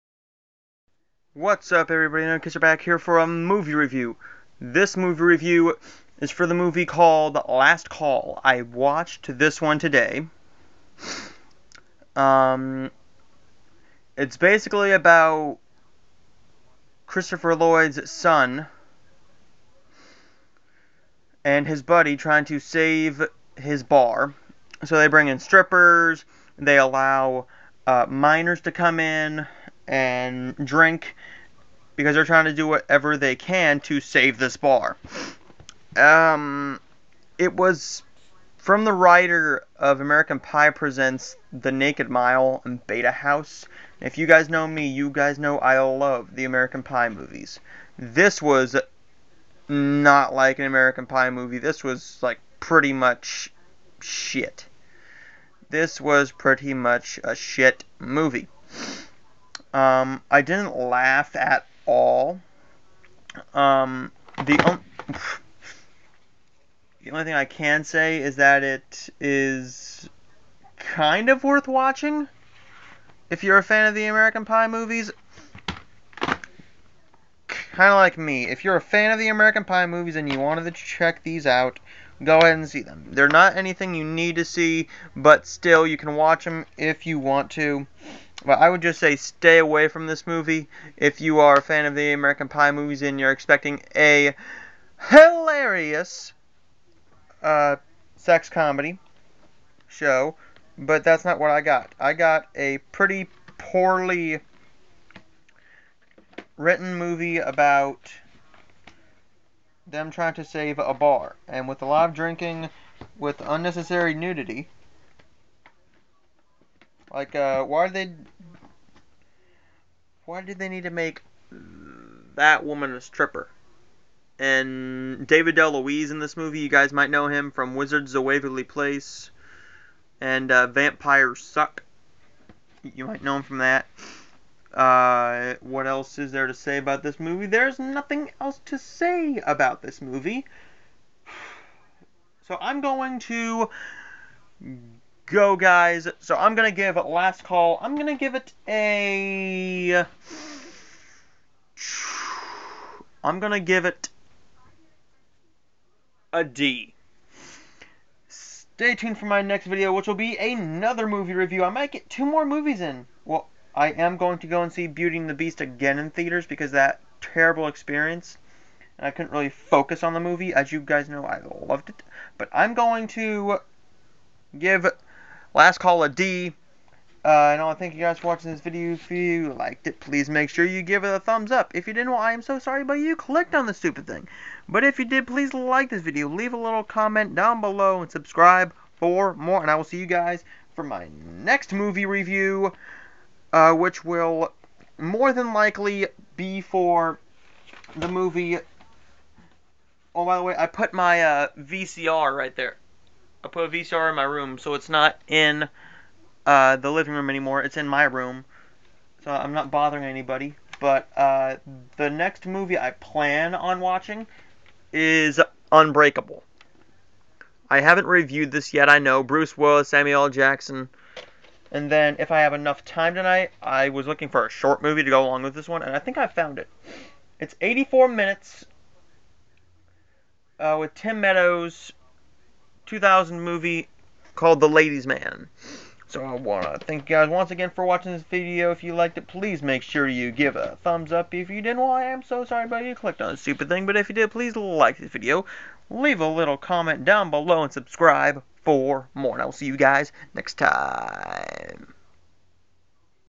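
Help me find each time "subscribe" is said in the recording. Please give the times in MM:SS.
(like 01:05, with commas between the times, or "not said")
03:08, 04:07.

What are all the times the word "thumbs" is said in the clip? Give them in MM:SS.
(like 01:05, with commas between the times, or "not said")
03:01, 04:00.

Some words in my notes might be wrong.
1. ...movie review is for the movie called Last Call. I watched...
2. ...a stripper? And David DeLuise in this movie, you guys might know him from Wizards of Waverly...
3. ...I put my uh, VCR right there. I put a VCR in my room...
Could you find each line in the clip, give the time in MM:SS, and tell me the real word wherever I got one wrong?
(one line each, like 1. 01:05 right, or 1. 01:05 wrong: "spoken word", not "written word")
1. 00:04 right
2. 02:02 right
3. 03:20 right.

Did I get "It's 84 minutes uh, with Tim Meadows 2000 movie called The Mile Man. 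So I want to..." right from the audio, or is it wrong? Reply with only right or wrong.
wrong.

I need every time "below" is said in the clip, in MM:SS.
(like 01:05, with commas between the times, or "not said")
03:07, 04:07.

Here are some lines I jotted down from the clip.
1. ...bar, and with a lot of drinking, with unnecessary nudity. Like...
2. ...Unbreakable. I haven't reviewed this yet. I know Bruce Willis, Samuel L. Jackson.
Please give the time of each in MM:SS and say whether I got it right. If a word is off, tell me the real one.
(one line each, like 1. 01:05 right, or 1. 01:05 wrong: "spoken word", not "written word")
1. 01:50 right
2. 03:35 right.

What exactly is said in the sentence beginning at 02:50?
As you guys know, I loved it.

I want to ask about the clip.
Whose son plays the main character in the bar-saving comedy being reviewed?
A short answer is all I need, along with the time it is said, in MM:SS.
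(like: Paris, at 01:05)
Christopher Lloyd, at 00:17.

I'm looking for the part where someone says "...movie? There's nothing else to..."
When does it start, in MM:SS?
02:17.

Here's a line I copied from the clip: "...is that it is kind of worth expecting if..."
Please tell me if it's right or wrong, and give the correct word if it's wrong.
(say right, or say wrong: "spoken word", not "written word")
wrong: "watching", not "expecting".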